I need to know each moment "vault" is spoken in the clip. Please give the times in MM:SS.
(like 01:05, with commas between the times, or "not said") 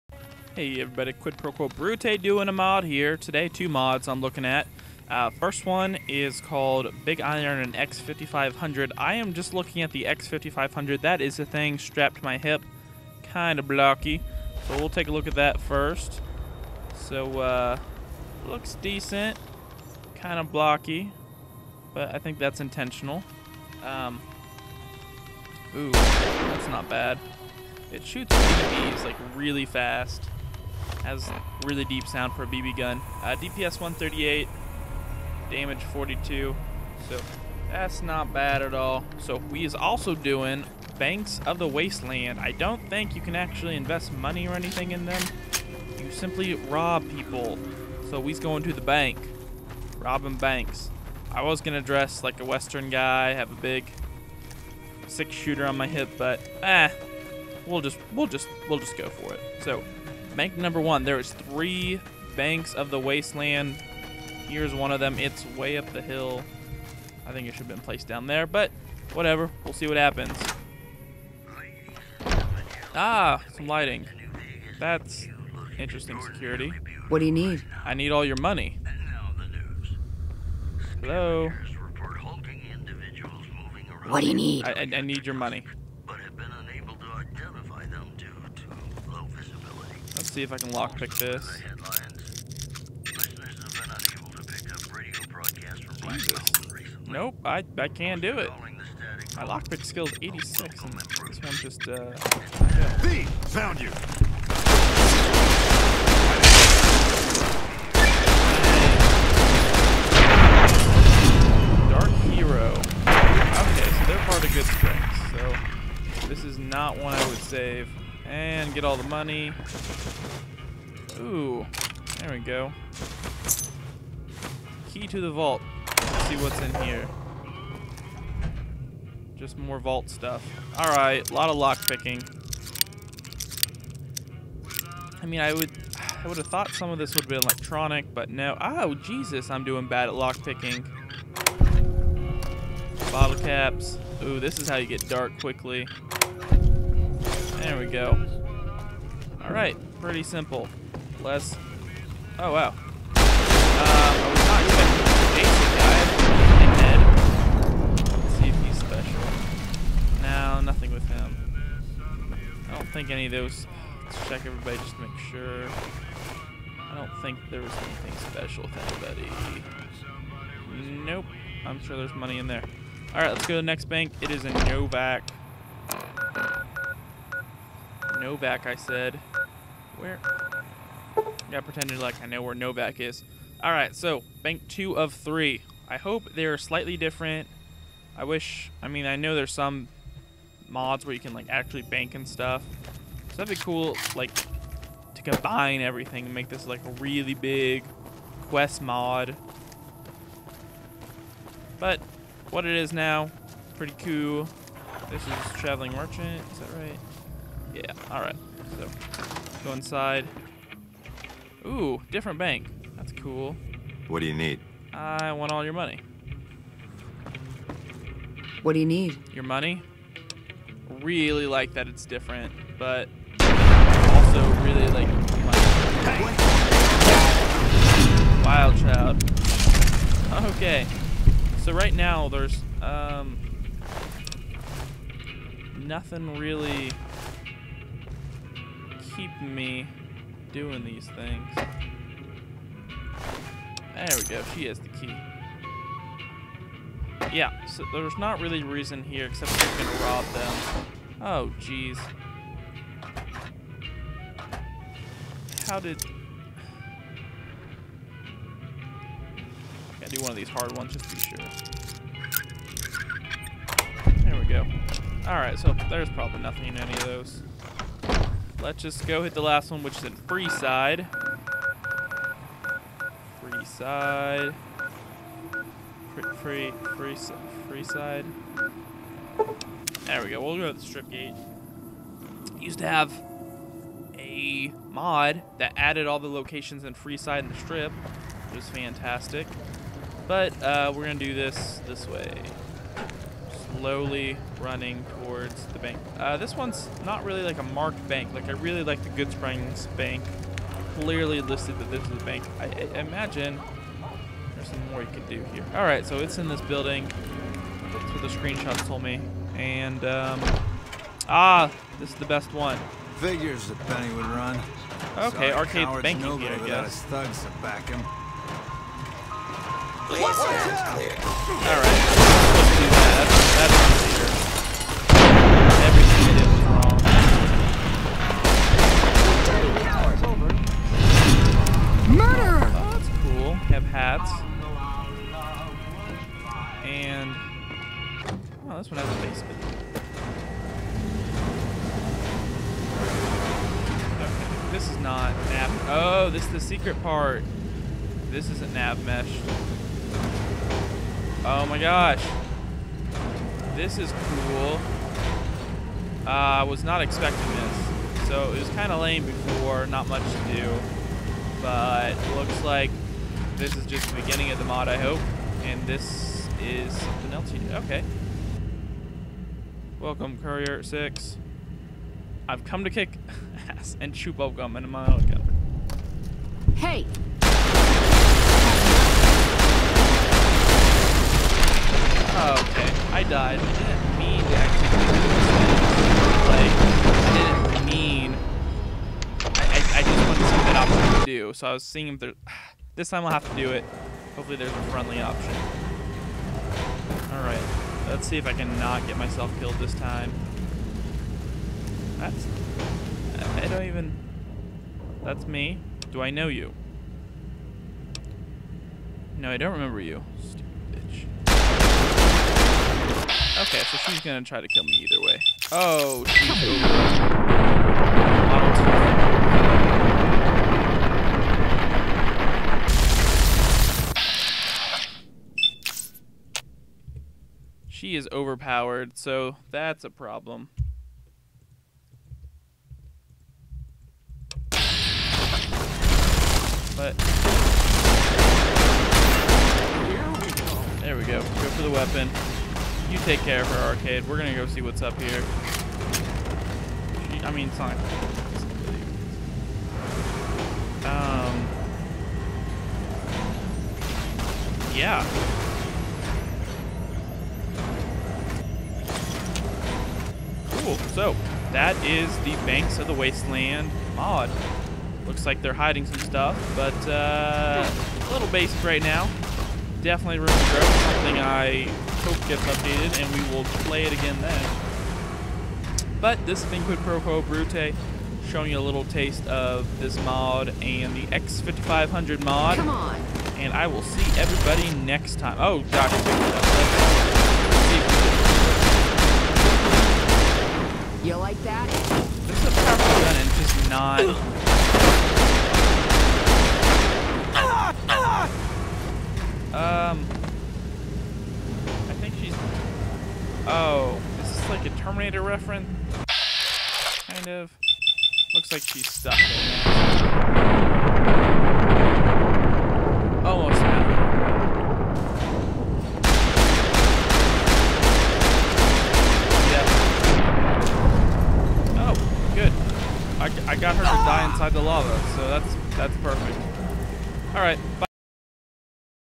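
02:05, 02:09.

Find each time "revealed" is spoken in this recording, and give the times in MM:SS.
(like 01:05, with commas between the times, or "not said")
not said.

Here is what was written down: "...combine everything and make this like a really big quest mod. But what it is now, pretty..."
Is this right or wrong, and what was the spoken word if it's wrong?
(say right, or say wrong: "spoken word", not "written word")
right.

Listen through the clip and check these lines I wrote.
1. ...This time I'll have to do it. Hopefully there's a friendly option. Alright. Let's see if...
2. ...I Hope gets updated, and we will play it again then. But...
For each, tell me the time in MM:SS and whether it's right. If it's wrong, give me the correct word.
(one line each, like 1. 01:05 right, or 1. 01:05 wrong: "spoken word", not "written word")
1. 06:32 right
2. 07:51 right.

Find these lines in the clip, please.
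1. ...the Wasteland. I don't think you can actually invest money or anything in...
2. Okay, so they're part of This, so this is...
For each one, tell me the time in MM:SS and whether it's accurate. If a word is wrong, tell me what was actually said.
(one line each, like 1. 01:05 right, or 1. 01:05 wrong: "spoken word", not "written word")
1. 00:41 right
2. 01:53 wrong: "Goodsprings", not "This".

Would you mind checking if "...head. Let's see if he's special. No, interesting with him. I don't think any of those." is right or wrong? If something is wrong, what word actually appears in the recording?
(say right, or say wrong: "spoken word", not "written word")
wrong: "nothing", not "interesting".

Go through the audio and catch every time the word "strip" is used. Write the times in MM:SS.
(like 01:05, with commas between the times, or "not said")
04:40, 04:47.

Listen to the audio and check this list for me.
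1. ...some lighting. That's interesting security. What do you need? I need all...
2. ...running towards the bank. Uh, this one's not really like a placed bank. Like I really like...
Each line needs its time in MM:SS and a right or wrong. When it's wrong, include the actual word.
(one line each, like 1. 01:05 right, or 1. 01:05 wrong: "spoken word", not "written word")
1. 01:13 right
2. 04:54 wrong: "marked", not "placed".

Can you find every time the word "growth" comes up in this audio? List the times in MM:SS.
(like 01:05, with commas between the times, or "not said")
07:50.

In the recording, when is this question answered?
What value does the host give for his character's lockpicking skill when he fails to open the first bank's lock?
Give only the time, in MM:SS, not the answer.
01:39.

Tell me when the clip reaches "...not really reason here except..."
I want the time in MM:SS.
04:08.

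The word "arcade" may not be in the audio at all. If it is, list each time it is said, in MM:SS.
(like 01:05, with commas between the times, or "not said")
05:15, 07:23.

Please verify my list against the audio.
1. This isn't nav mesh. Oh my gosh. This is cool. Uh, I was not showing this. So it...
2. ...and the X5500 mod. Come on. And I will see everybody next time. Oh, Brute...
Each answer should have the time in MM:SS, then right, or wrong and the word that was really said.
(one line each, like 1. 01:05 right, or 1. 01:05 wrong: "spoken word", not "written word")
1. 05:48 wrong: "expecting", not "showing"
2. 08:00 wrong: "Doc", not "Brute".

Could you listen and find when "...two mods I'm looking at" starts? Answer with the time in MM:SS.
00:03.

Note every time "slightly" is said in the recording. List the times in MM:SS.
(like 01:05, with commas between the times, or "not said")
03:06.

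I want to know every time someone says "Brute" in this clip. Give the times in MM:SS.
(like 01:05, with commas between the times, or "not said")
00:01, 07:57.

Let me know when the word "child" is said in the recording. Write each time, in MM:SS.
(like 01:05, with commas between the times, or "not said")
03:48.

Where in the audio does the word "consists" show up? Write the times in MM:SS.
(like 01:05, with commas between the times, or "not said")
not said.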